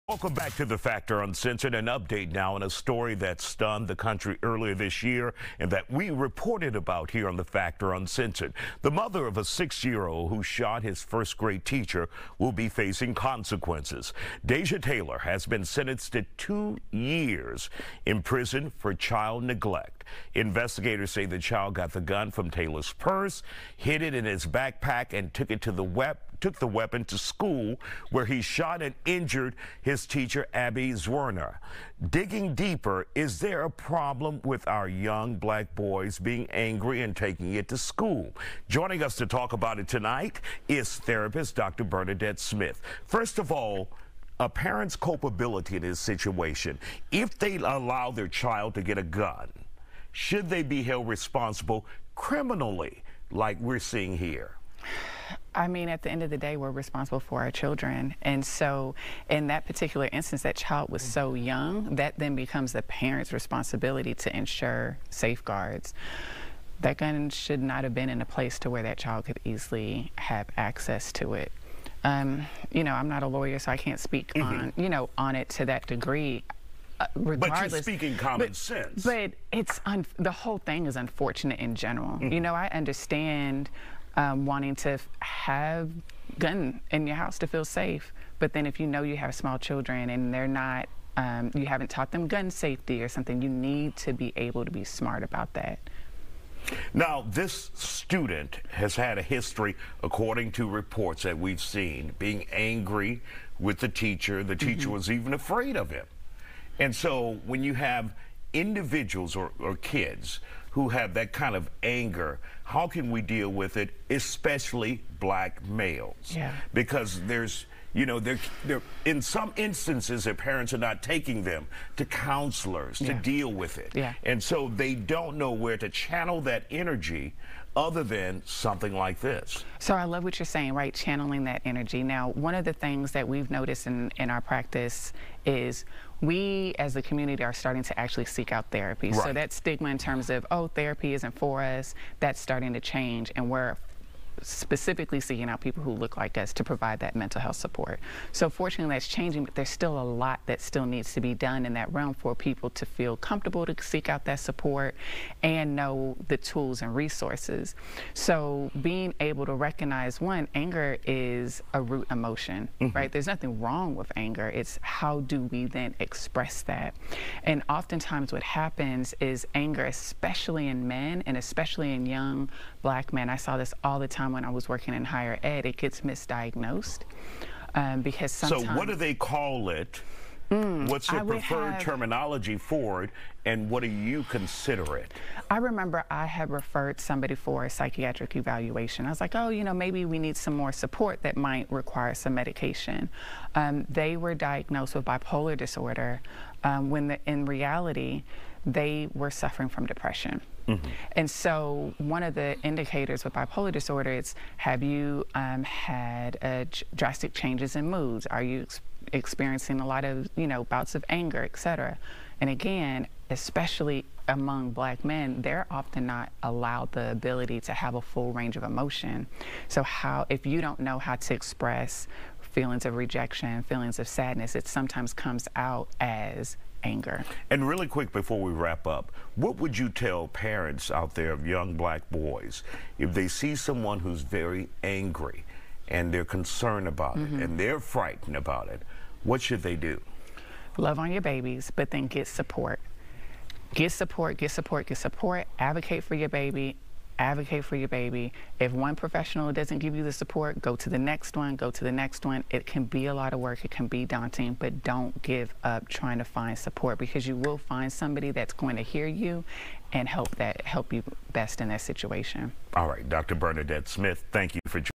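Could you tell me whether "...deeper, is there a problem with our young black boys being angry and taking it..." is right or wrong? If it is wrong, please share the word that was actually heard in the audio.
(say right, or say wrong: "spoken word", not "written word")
right.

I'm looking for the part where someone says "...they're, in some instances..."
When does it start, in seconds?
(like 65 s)
118 s.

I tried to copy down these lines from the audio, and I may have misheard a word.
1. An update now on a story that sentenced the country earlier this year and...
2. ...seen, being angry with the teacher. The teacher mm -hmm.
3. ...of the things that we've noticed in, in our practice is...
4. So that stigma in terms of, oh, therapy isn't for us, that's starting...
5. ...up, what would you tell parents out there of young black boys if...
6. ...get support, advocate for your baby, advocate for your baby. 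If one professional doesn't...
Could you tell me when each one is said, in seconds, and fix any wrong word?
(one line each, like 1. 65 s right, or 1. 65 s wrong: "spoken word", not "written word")
1. 1 s wrong: "stunned", not "sentenced"
2. 101 s right
3. 132 s right
4. 139 s right
5. 228 s right
6. 244 s right.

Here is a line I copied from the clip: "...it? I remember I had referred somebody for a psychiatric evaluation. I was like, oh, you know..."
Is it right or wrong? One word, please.
right.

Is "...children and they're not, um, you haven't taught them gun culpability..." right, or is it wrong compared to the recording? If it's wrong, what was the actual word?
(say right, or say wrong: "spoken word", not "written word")
wrong: "safety", not "culpability".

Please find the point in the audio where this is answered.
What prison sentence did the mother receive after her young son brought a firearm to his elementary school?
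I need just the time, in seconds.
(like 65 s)
16 s.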